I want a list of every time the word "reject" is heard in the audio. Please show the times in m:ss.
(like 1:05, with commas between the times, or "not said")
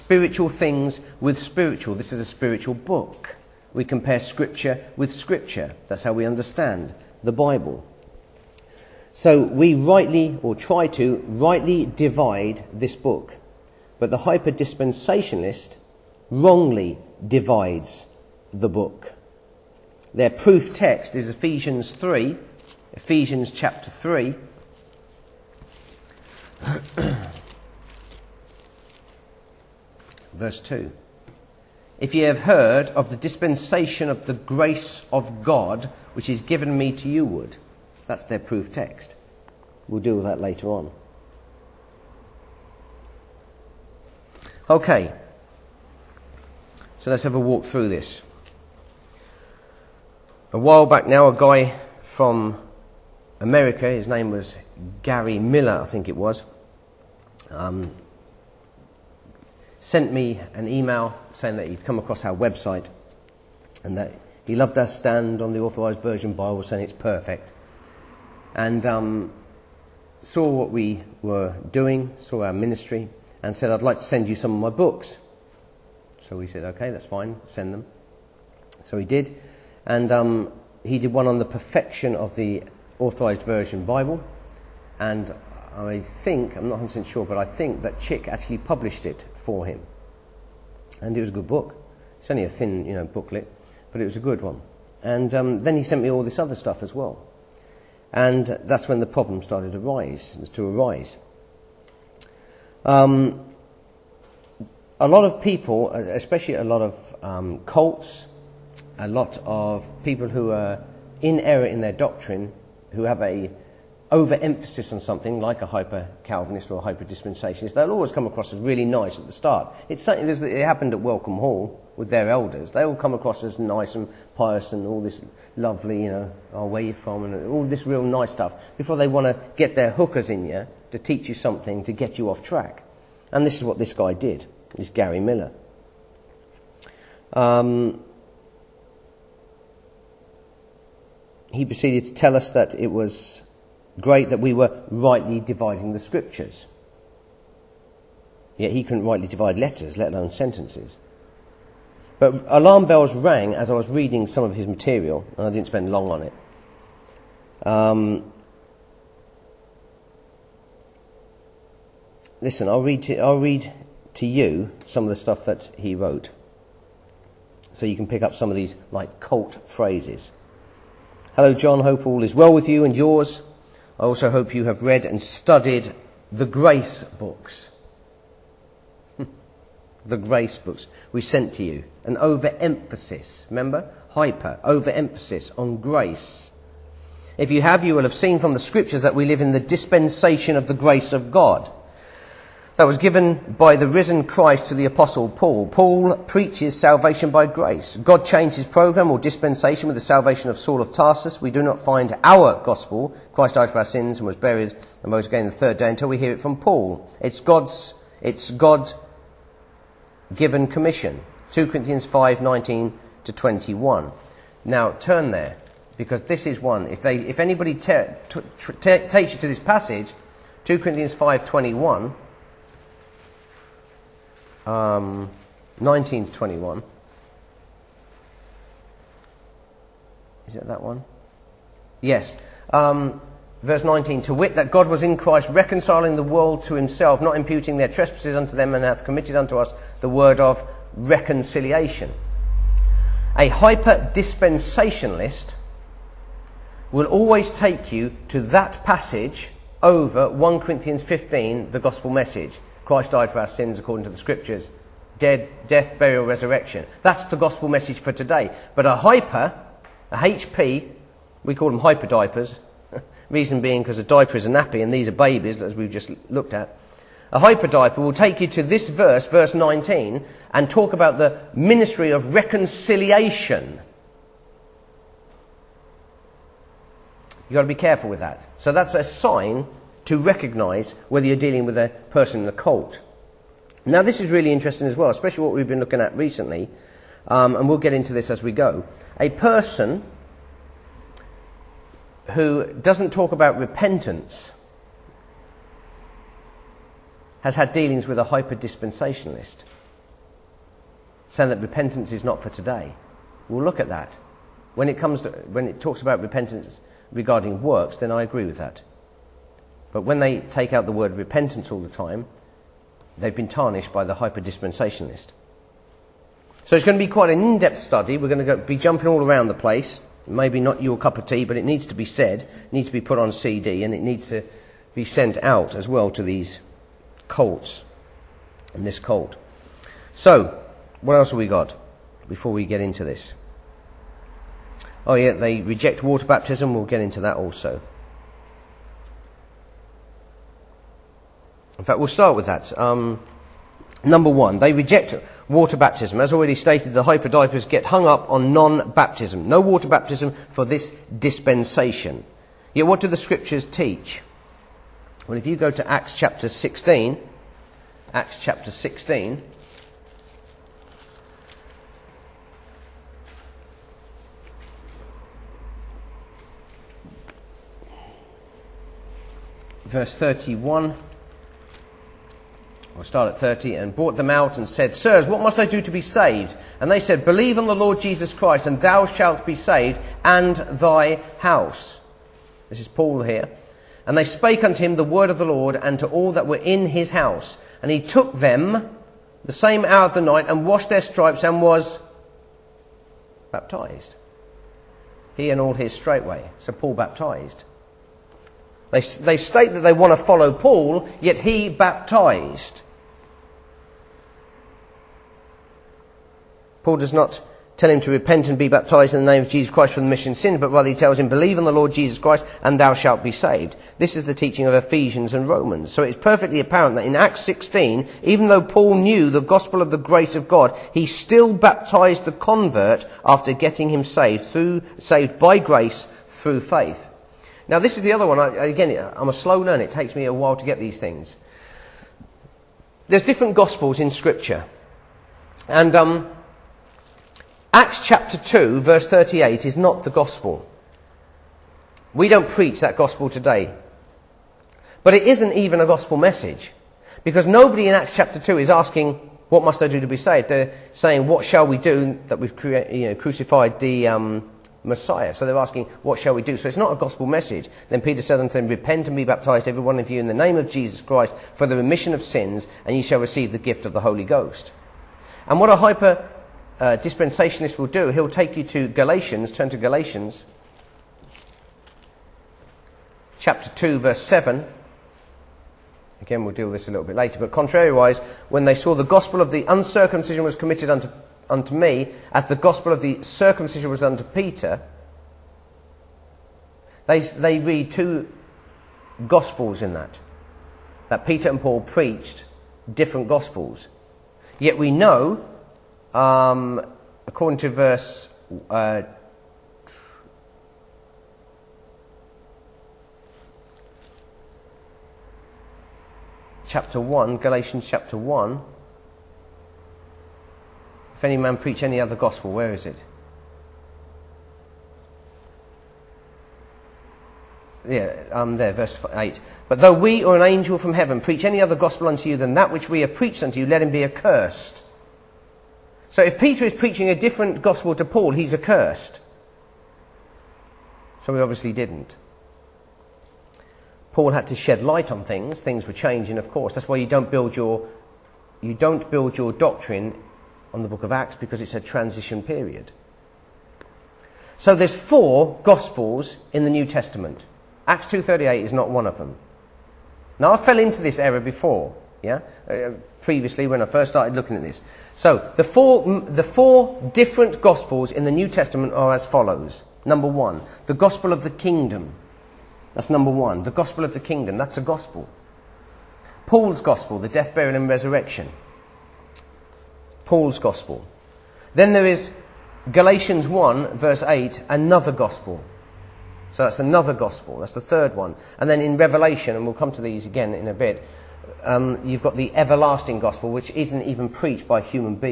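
5:35, 5:44.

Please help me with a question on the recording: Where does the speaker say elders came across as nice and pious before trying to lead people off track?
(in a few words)
Welcome Hall.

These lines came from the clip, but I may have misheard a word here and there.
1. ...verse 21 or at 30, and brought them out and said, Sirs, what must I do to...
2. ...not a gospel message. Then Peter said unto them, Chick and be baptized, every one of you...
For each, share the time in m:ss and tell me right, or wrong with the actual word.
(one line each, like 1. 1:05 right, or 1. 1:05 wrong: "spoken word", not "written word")
1. 6:09 wrong: "31", not "21"
2. 7:36 wrong: "Repent", not "Chick".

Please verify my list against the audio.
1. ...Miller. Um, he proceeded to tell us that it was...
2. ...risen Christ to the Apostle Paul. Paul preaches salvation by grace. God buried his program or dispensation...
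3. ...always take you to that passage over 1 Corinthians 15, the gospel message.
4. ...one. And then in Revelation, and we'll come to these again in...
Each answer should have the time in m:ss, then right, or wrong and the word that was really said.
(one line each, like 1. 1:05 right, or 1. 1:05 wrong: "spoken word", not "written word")
1. 2:15 right
2. 3:13 wrong: "changed", not "buried"
3. 4:07 right
4. 9:38 right.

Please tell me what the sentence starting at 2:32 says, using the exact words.
But alarm bells rang as I was reading some of his material, and I didn't spend long on it.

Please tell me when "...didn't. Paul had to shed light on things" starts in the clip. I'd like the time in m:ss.
8:51.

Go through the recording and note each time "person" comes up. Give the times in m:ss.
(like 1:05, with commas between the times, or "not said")
4:42, 4:49.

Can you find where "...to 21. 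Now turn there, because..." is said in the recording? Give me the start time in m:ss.
3:33.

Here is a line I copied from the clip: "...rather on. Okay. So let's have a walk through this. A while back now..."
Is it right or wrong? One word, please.
wrong.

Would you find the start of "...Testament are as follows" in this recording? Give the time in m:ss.
9:18.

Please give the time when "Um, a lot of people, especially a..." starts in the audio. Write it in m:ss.
1:42.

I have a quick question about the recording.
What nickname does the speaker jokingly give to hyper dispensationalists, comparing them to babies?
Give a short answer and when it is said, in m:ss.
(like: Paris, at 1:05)
hyper diapers, at 4:21.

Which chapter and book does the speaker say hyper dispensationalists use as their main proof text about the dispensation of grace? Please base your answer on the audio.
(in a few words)
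Ephesians 3.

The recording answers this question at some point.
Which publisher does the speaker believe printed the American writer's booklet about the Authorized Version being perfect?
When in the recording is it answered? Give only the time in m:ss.
1:27.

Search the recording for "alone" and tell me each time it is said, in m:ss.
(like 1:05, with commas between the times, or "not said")
2:30.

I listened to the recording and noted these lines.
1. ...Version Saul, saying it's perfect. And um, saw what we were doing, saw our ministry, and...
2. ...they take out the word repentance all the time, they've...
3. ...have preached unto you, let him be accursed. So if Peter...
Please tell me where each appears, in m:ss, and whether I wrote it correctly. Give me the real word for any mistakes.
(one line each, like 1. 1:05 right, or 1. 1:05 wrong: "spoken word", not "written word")
1. 1:05 wrong: "Bible", not "Saul"
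2. 5:10 right
3. 8:42 right.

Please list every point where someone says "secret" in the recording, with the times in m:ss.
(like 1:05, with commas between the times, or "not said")
not said.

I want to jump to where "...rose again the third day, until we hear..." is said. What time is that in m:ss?
3:25.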